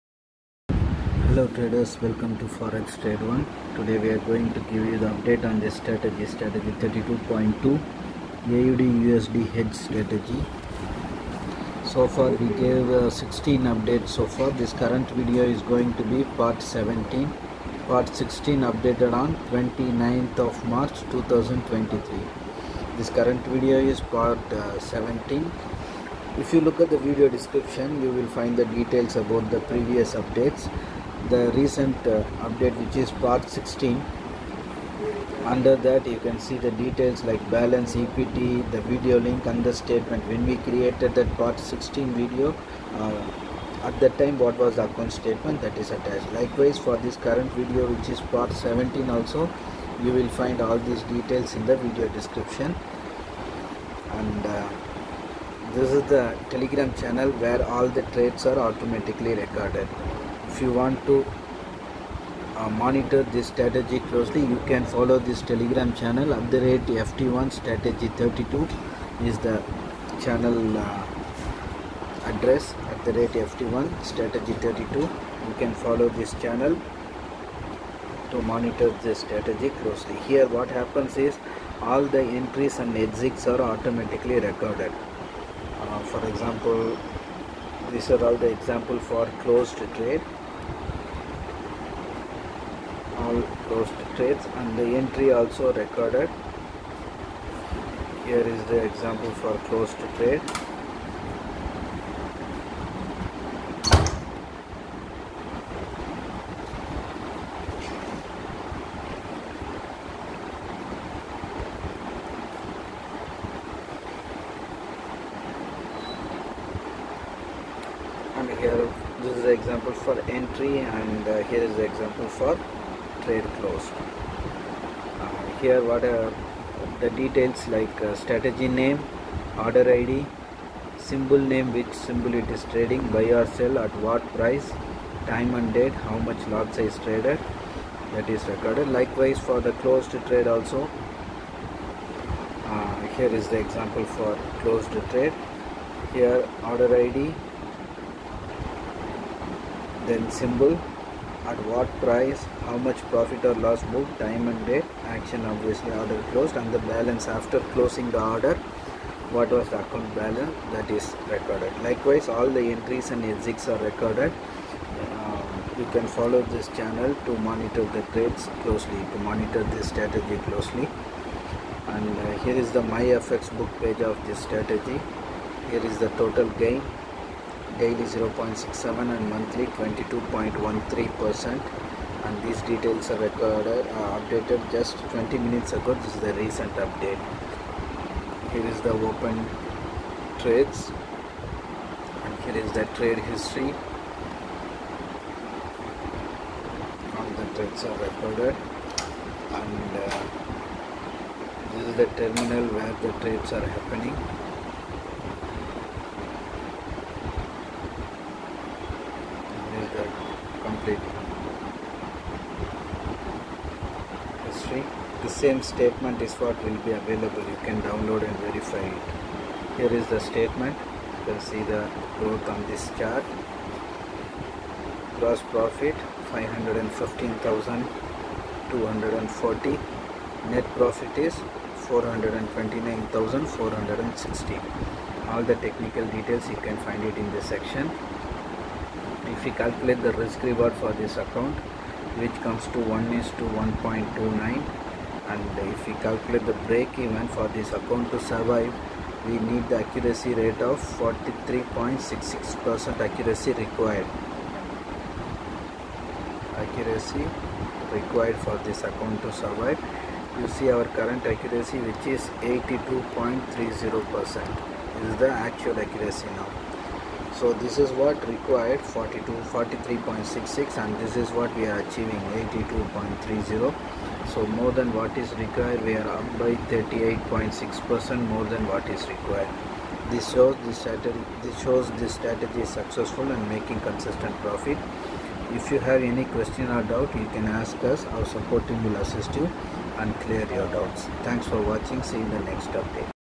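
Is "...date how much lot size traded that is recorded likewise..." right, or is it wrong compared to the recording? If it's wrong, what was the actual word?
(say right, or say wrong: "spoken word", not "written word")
right.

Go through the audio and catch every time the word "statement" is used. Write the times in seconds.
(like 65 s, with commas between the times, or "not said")
39 s, 45 s, 215 s, 220 s.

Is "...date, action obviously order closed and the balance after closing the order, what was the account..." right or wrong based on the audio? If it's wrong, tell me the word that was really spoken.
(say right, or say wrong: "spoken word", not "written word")
right.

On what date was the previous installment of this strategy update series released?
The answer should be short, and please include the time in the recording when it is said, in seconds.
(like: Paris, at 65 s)
29th of March 2023, at 19 s.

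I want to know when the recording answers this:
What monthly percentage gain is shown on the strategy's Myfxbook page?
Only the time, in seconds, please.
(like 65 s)
179 s.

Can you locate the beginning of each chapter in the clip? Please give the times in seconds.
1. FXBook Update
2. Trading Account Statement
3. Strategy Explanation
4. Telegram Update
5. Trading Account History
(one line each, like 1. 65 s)
1. 172 s
2. 218 s
3. 30 s
4. 55 s
5. 200 s.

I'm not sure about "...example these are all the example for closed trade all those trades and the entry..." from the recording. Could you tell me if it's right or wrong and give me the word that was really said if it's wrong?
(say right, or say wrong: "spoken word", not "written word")
right.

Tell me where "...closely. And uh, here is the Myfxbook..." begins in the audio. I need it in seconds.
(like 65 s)
170 s.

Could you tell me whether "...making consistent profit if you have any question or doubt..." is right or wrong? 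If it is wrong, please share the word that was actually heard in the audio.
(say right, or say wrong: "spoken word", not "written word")
right.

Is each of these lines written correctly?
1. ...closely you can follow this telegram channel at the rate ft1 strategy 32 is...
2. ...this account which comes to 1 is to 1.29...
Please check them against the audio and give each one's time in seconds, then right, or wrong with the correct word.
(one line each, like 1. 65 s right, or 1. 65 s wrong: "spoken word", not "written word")
1. 64 s right
2. 240 s right.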